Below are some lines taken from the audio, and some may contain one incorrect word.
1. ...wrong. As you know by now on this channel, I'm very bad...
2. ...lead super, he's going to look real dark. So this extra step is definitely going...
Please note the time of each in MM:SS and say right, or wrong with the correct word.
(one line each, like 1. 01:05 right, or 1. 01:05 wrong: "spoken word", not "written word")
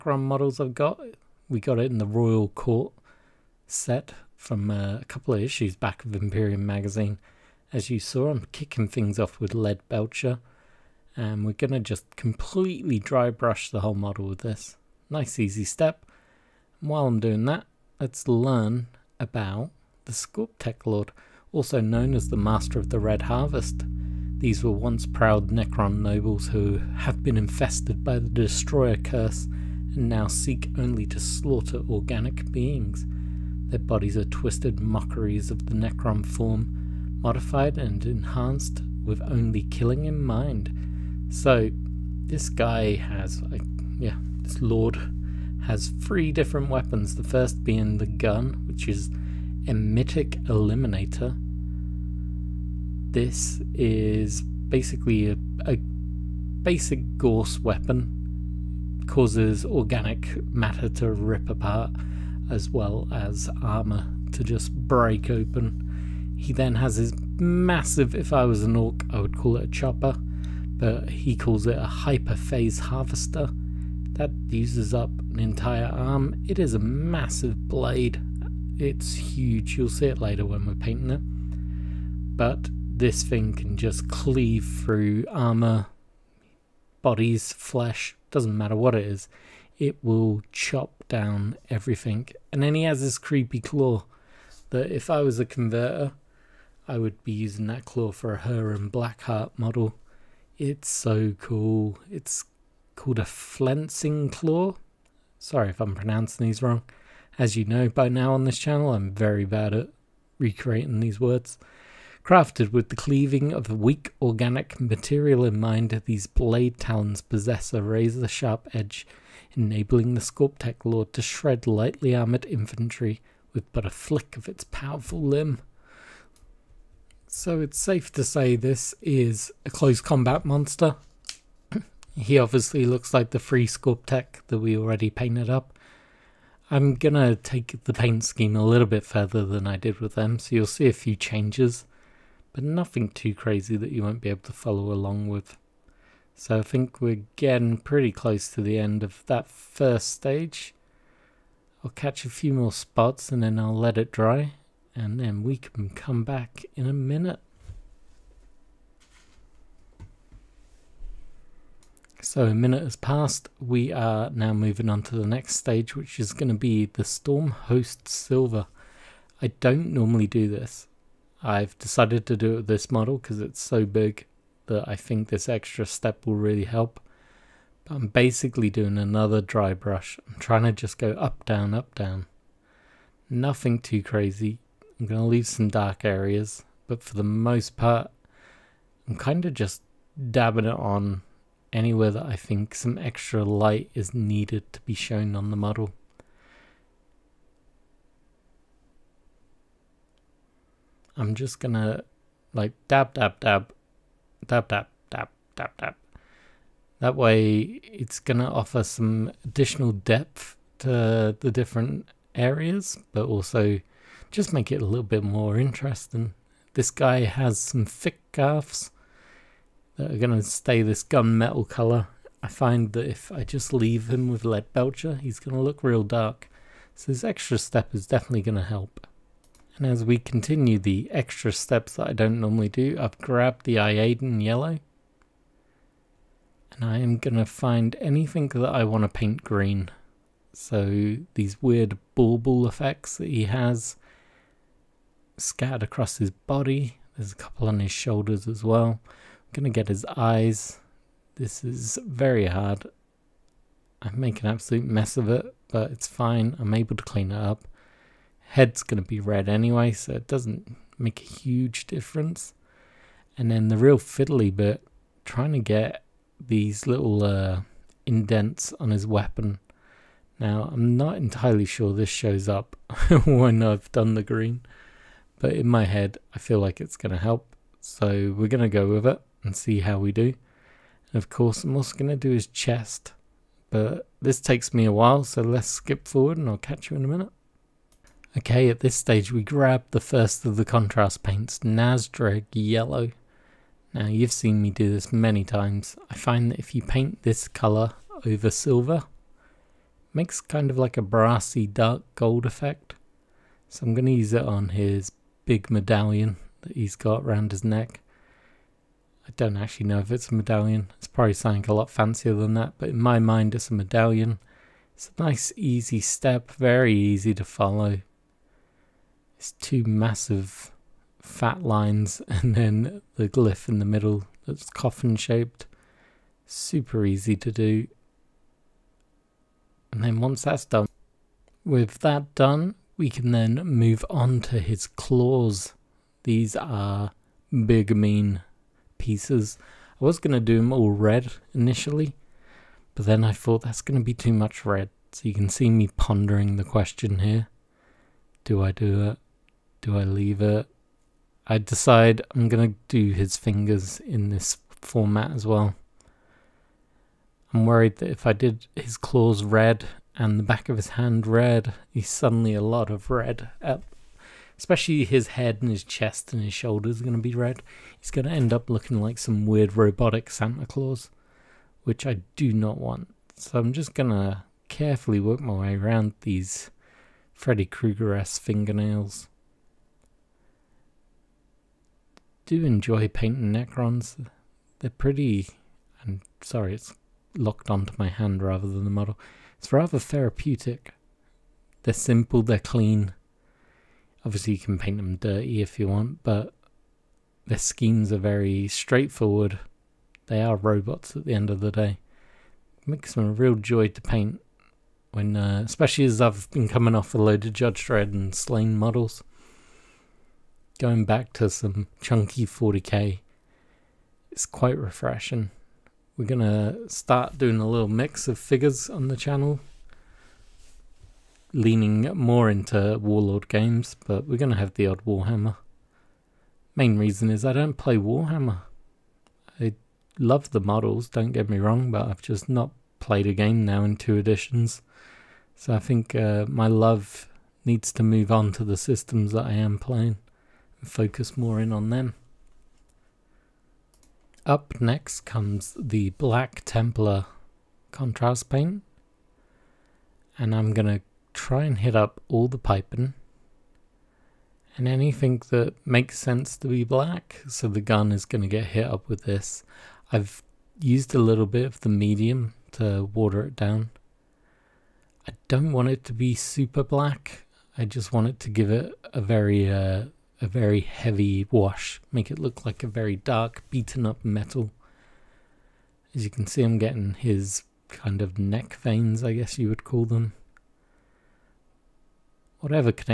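1. 01:46 right
2. 03:44 wrong: "belcher", not "super".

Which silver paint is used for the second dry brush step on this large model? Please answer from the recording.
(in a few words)
Stormhost Silver.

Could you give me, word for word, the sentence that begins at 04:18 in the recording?
Head's gonna be red anyway, so it doesn't make a huge difference.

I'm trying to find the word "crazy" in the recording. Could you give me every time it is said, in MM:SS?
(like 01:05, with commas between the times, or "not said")
02:23, 03:04.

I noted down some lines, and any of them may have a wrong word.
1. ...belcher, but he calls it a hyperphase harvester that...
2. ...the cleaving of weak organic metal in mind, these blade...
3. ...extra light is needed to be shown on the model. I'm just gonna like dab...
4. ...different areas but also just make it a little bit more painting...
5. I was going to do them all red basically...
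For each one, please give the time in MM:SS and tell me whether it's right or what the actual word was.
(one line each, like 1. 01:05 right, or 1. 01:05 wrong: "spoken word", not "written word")
1. 01:09 wrong: "chopper", not "belcher"
2. 01:52 wrong: "material", not "metal"
3. 03:12 right
4. 03:31 wrong: "interesting", not "painting"
5. 05:40 wrong: "initially", not "basically".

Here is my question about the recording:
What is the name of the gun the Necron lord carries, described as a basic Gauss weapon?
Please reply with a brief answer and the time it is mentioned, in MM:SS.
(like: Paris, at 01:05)
Enmitic Eliminator, at 00:49.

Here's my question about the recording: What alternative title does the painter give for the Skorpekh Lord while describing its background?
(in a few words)
Master of the Red Harvest.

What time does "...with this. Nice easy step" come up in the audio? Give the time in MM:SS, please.
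00:14.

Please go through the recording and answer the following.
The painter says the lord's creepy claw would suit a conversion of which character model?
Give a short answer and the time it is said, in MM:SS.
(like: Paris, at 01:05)
Huron Blackheart, at 01:38.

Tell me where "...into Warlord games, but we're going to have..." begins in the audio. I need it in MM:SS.
07:02.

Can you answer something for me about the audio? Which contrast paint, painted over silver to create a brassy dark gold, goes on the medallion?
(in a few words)
Nazdreg Yellow.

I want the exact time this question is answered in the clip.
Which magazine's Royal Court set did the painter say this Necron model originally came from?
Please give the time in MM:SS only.
00:06.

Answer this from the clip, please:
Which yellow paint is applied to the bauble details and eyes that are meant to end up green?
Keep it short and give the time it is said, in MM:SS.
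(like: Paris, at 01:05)
Iyanden yellow, at 03:53.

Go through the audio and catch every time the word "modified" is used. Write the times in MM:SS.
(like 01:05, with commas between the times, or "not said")
00:37.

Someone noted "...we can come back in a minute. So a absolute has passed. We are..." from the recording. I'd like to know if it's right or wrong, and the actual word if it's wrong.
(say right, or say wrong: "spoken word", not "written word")
wrong: "minute", not "absolute".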